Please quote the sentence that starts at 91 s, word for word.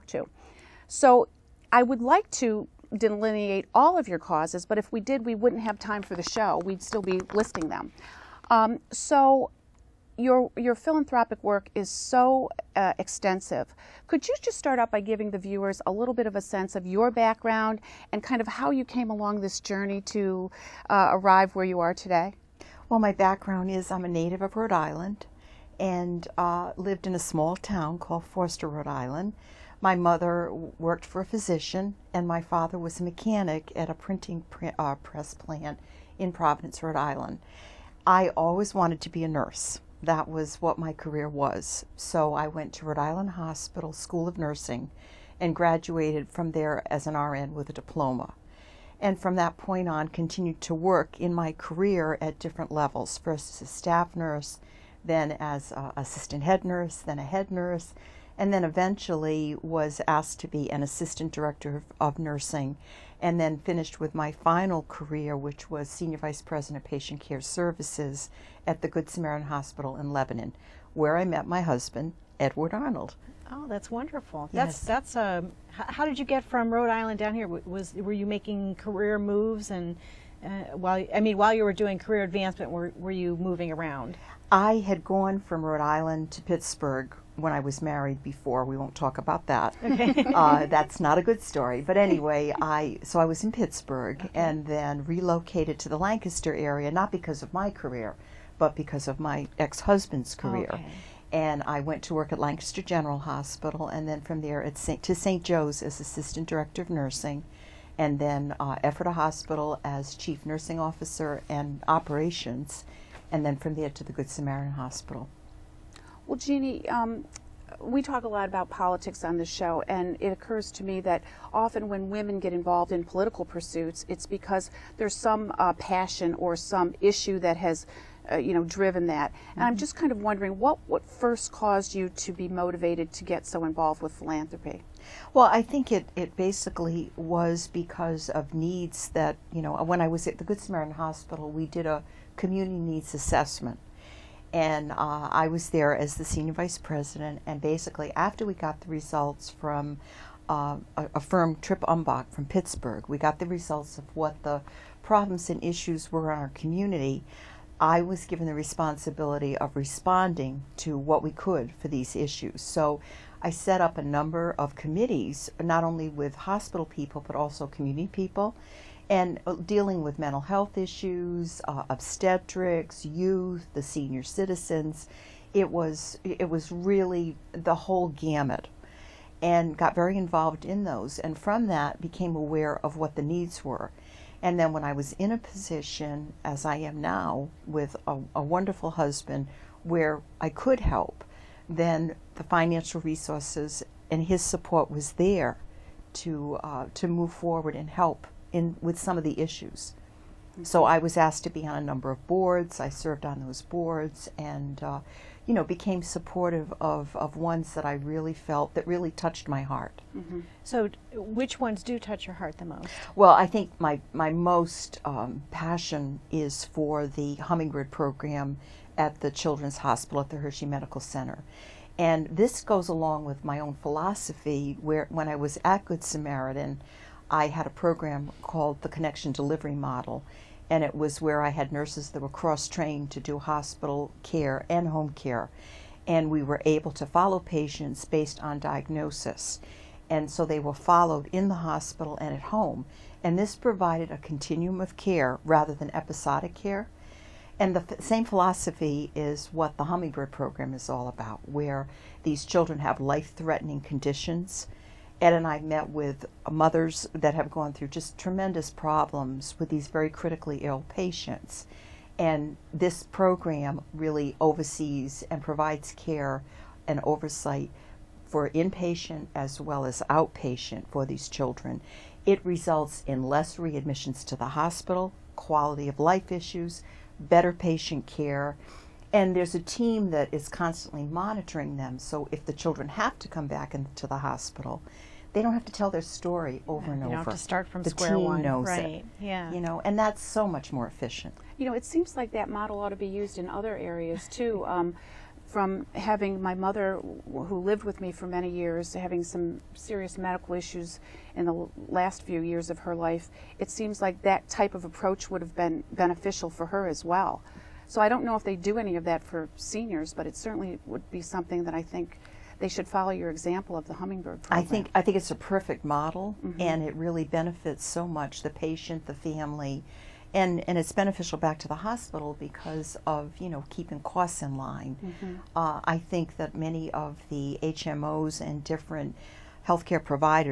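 But anyway, I so I was in Pittsburgh okay.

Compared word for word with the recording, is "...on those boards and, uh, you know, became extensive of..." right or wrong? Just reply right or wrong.
wrong.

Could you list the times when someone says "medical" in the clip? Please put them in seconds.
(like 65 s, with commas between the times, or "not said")
220 s, 300 s.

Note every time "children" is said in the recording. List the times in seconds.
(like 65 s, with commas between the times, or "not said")
219 s, 252 s, 271 s, 282 s.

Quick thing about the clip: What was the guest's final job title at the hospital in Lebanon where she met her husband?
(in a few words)
Senior vice president of patient care services.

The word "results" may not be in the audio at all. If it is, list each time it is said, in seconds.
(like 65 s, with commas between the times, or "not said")
148 s, 153 s, 272 s.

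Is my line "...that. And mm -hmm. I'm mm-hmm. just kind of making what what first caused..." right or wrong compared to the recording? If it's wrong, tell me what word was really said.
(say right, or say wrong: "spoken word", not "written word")
wrong: "wondering", not "making".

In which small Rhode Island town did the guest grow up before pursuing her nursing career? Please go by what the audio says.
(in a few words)
Foster.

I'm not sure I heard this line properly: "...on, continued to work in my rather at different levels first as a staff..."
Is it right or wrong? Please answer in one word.
wrong.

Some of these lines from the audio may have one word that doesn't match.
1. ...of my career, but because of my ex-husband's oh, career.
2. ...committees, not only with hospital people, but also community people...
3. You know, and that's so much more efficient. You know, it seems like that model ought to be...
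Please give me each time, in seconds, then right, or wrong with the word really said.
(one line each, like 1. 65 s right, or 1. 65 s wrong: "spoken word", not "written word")
1. 97 s right
2. 164 s right
3. 289 s right.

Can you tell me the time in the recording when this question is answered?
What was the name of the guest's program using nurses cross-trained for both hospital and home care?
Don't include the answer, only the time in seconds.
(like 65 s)
228 s.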